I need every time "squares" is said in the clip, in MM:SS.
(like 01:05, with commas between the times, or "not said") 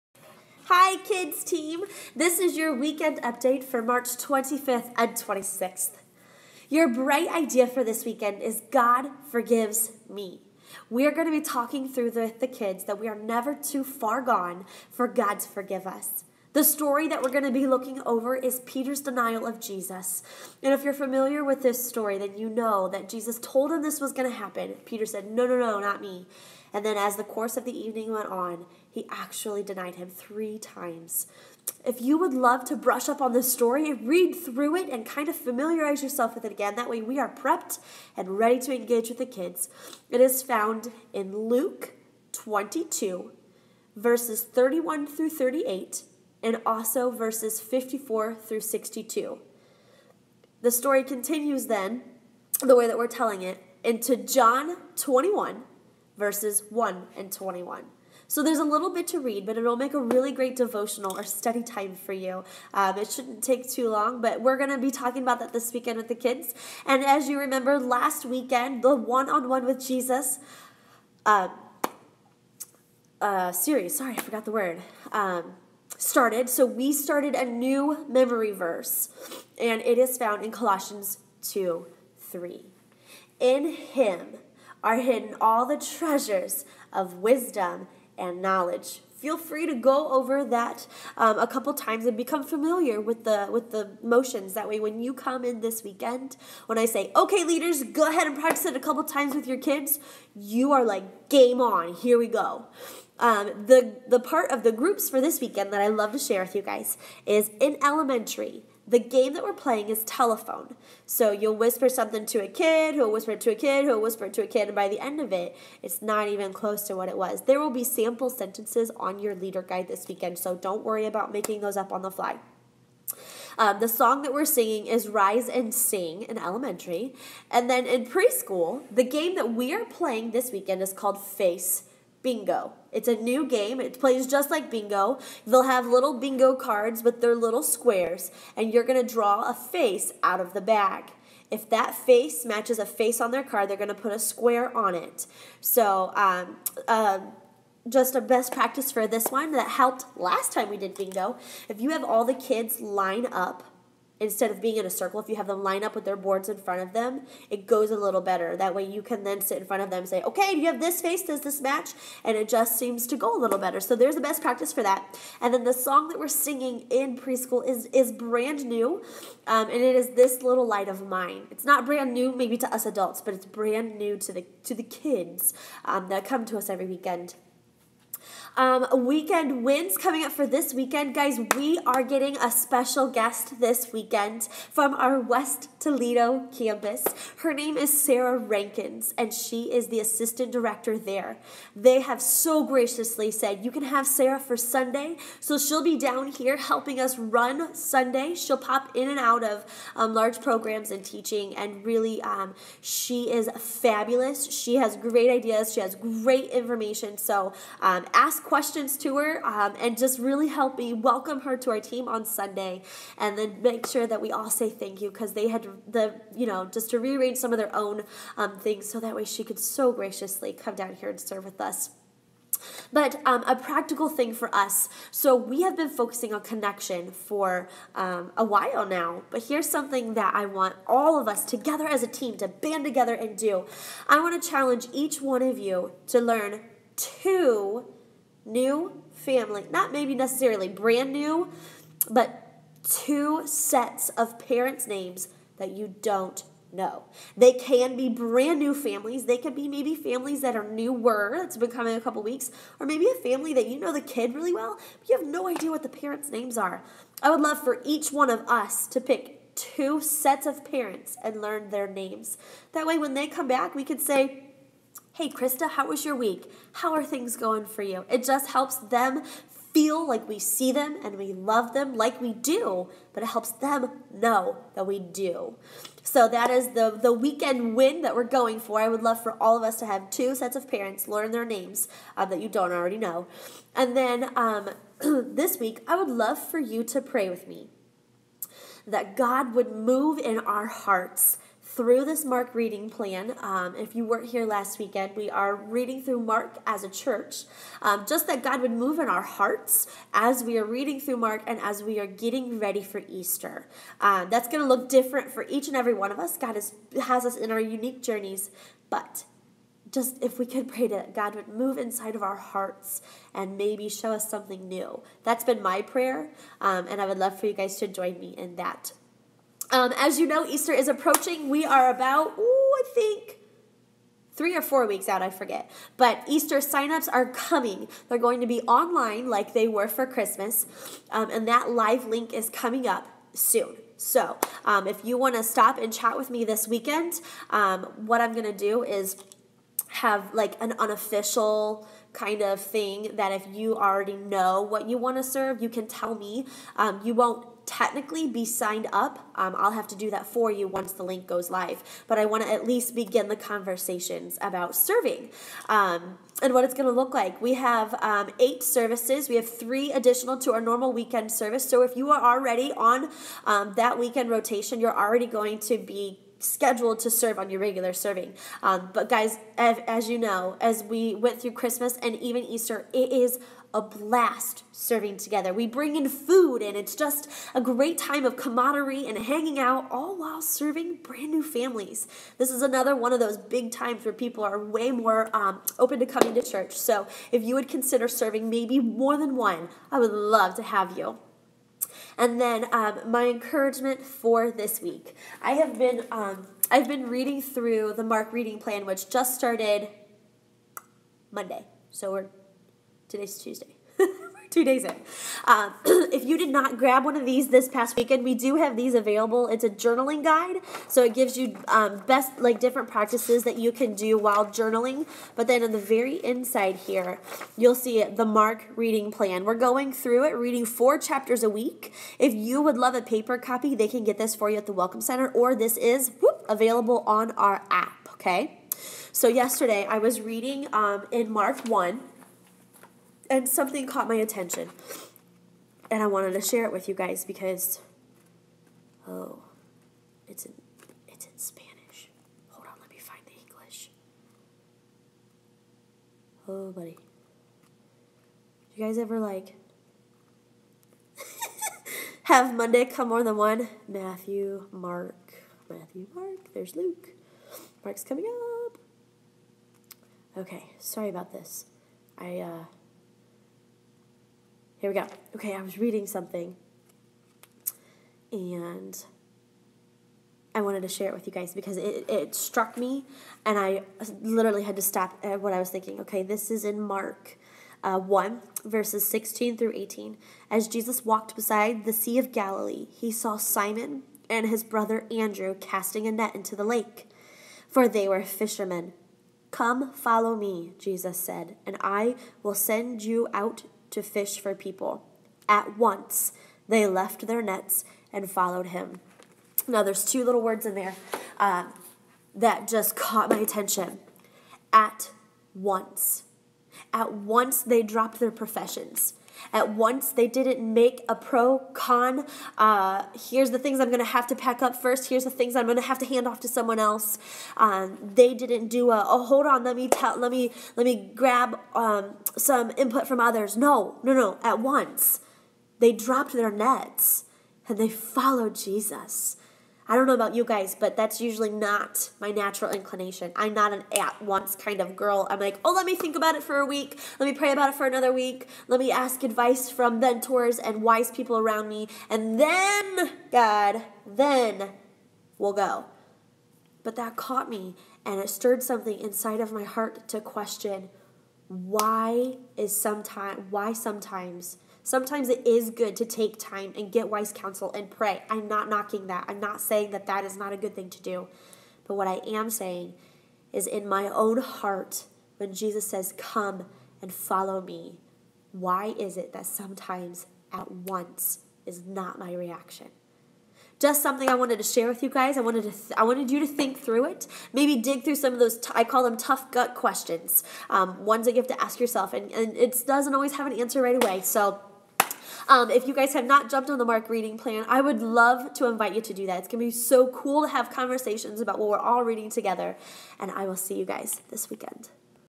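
02:17, 02:24.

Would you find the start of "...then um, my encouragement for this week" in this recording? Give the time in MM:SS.
06:32.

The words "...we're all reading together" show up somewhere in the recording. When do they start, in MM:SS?
09:51.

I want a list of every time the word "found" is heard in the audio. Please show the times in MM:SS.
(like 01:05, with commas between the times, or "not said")
00:40, 01:20.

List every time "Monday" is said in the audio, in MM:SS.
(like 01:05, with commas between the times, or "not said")
06:41, 07:32.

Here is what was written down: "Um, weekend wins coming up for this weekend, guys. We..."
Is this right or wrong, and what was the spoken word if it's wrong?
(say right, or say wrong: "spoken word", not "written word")
right.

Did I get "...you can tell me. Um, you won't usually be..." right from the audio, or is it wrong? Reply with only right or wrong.
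wrong.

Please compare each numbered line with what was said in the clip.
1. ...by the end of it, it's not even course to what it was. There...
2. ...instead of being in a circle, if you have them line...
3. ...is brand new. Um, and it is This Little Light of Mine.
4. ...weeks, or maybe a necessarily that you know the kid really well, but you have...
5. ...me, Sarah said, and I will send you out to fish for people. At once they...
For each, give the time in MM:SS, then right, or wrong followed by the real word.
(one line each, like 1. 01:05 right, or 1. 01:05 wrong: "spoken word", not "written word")
1. 01:54 wrong: "close", not "course"
2. 02:34 right
3. 02:47 right
4. 04:12 wrong: "family", not "necessarily"
5. 08:10 wrong: "Jesus", not "Sarah".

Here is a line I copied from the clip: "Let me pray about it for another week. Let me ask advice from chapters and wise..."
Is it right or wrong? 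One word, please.
wrong.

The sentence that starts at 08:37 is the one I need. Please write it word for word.
Um, they didn't do a oh hold on let me tell let me let me grab um, some input from others.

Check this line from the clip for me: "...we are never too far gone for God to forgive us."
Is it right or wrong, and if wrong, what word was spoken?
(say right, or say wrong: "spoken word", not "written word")
right.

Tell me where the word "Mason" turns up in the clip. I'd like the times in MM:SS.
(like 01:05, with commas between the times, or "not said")
not said.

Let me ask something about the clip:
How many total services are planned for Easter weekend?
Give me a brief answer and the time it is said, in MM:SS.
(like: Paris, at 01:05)
8, at 05:58.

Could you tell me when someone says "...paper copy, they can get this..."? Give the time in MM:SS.
07:03.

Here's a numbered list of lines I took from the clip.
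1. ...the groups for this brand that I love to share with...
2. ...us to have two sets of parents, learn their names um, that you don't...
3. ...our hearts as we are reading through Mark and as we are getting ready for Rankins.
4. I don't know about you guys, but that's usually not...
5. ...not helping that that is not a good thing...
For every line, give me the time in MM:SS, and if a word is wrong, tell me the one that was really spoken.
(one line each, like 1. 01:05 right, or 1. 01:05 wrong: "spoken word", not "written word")
1. 01:44 wrong: "weekend", not "brand"
2. 04:39 right
3. 04:59 wrong: "Easter", not "Rankins"
4. 08:49 right
5. 09:19 wrong: "saying", not "helping".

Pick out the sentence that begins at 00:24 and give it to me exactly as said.
Peter said, No, no, no, not me.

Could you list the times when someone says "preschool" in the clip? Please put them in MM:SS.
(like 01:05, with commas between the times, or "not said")
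02:08, 02:47.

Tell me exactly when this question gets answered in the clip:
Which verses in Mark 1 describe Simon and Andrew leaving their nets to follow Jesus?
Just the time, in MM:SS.
07:59.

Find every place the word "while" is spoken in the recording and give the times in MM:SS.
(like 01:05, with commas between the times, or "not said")
03:48, 06:20, 06:54.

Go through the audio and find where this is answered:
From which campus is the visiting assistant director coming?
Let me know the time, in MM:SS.
03:05.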